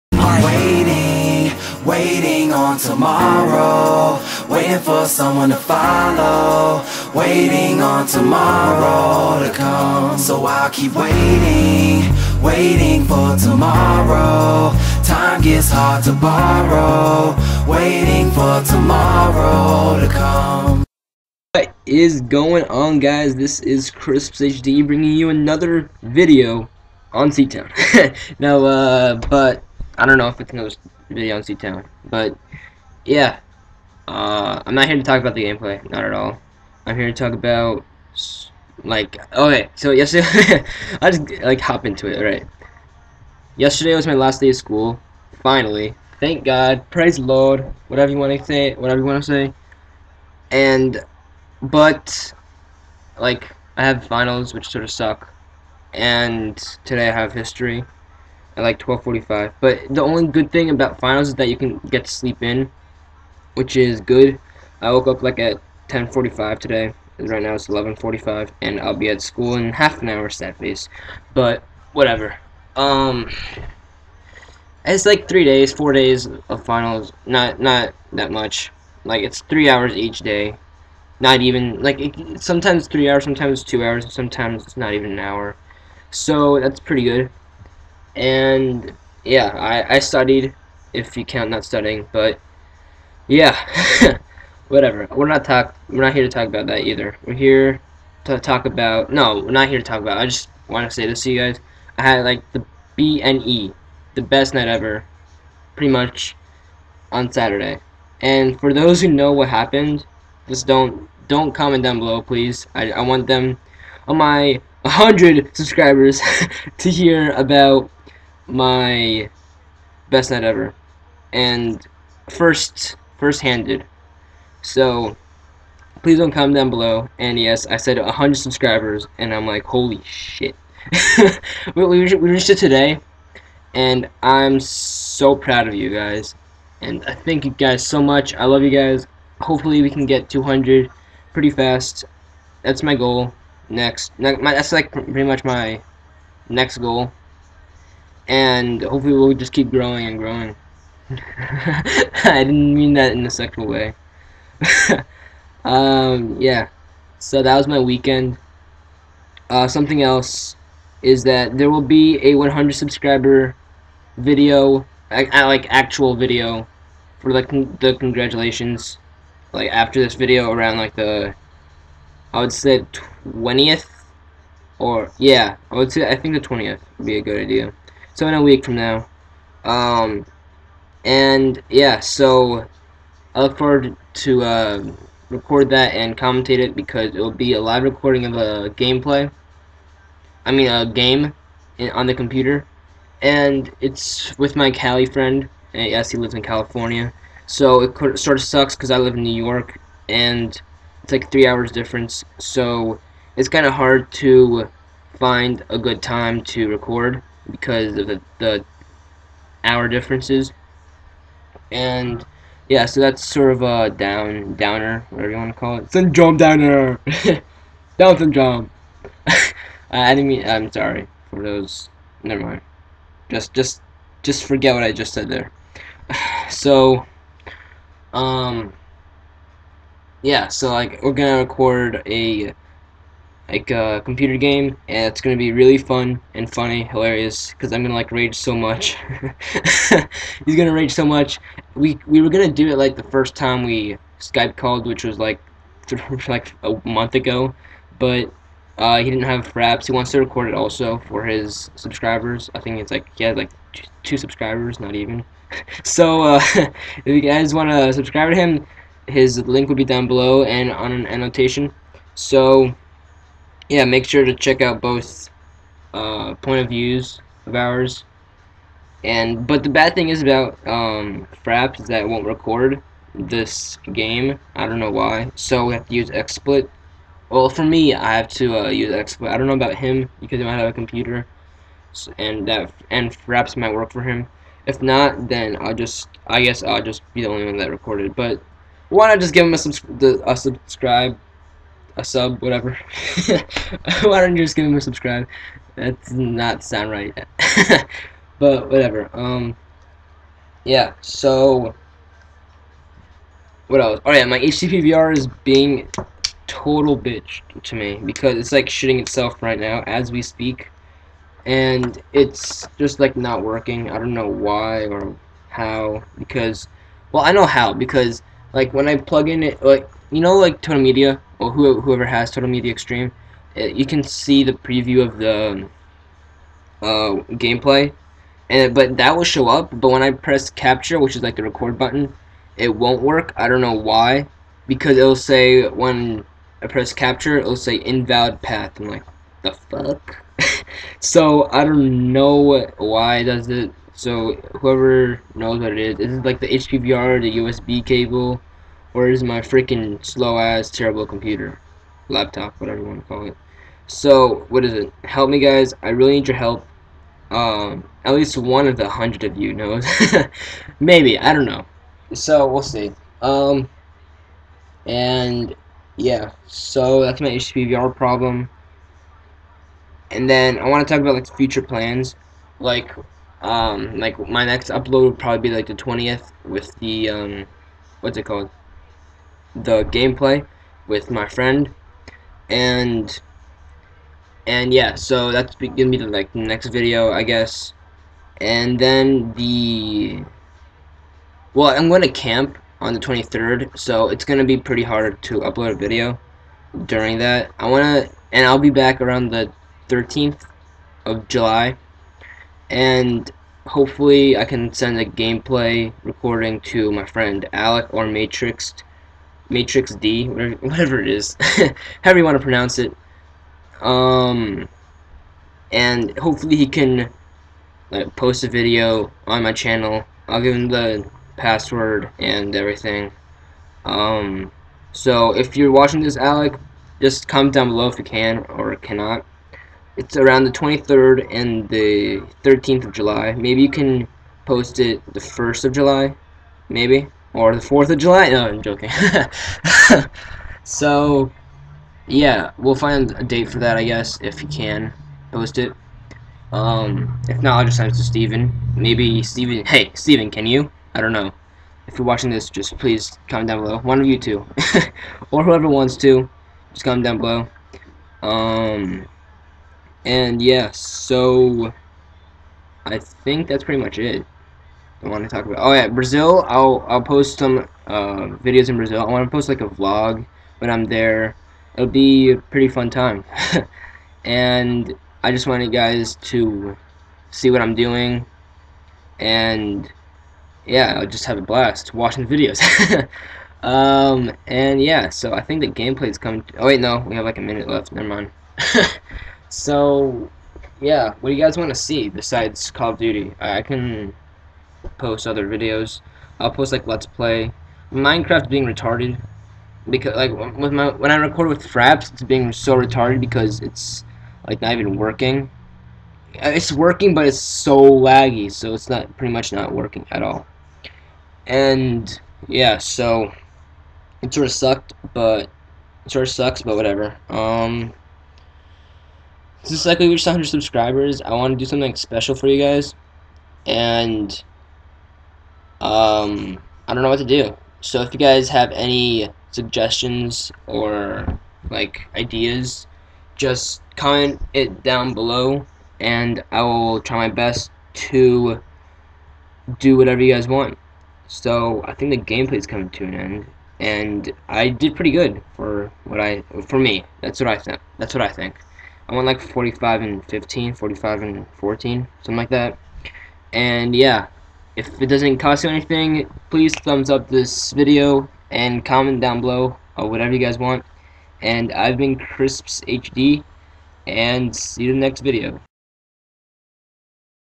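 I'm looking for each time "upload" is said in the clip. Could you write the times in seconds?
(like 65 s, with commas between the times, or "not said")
374 s, 395 s.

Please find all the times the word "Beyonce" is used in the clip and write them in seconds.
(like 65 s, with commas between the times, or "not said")
31 s.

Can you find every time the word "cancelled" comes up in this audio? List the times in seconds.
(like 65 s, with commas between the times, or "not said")
not said.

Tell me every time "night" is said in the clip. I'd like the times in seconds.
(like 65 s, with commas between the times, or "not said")
104 s, 120 s.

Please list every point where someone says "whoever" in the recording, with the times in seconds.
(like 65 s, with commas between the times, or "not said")
321 s, 344 s, 455 s.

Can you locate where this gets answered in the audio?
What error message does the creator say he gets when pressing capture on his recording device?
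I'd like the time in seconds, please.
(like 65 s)
337 s.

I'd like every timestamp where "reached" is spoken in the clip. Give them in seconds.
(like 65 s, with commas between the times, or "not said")
132 s, 520 s.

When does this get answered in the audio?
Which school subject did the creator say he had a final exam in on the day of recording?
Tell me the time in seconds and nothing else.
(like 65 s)
57 s.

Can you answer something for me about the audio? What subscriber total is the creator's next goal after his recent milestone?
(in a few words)
200.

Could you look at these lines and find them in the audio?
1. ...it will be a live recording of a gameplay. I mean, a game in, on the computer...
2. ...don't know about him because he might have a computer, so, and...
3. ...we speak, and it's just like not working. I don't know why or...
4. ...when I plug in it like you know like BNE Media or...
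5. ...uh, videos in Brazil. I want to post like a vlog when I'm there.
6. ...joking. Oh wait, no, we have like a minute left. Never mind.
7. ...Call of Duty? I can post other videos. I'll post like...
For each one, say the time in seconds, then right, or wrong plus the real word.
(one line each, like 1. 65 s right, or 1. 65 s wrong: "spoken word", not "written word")
1. 187 s right
2. 279 s right
3. 310 s right
4. 318 s wrong: "Total", not "BNE"
5. 467 s right
6. 486 s wrong: "coming", not "joking"
7. 492 s right.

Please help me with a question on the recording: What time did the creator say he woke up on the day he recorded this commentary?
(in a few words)
10:45.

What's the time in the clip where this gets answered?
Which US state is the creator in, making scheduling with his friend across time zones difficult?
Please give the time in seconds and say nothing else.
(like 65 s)
199 s.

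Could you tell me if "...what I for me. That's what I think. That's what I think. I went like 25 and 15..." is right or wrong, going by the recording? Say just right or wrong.
wrong.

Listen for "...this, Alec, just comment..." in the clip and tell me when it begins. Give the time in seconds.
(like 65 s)
426 s.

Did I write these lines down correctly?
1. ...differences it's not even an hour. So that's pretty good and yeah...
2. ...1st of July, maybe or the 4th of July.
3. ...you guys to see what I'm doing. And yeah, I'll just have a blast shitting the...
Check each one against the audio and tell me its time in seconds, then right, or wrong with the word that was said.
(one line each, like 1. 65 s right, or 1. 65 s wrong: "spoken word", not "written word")
1. 84 s wrong: "sometimes", not "differences"
2. 435 s right
3. 475 s wrong: "watching", not "shitting".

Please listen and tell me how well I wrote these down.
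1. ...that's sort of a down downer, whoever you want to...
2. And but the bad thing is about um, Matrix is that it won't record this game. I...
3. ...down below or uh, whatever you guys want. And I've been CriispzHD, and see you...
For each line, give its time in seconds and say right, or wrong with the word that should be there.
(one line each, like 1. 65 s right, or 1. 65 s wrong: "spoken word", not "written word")
1. 213 s wrong: "whatever", not "whoever"
2. 269 s wrong: "Fraps", not "Matrix"
3. 559 s right.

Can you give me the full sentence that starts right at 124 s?
So please don't comment down below.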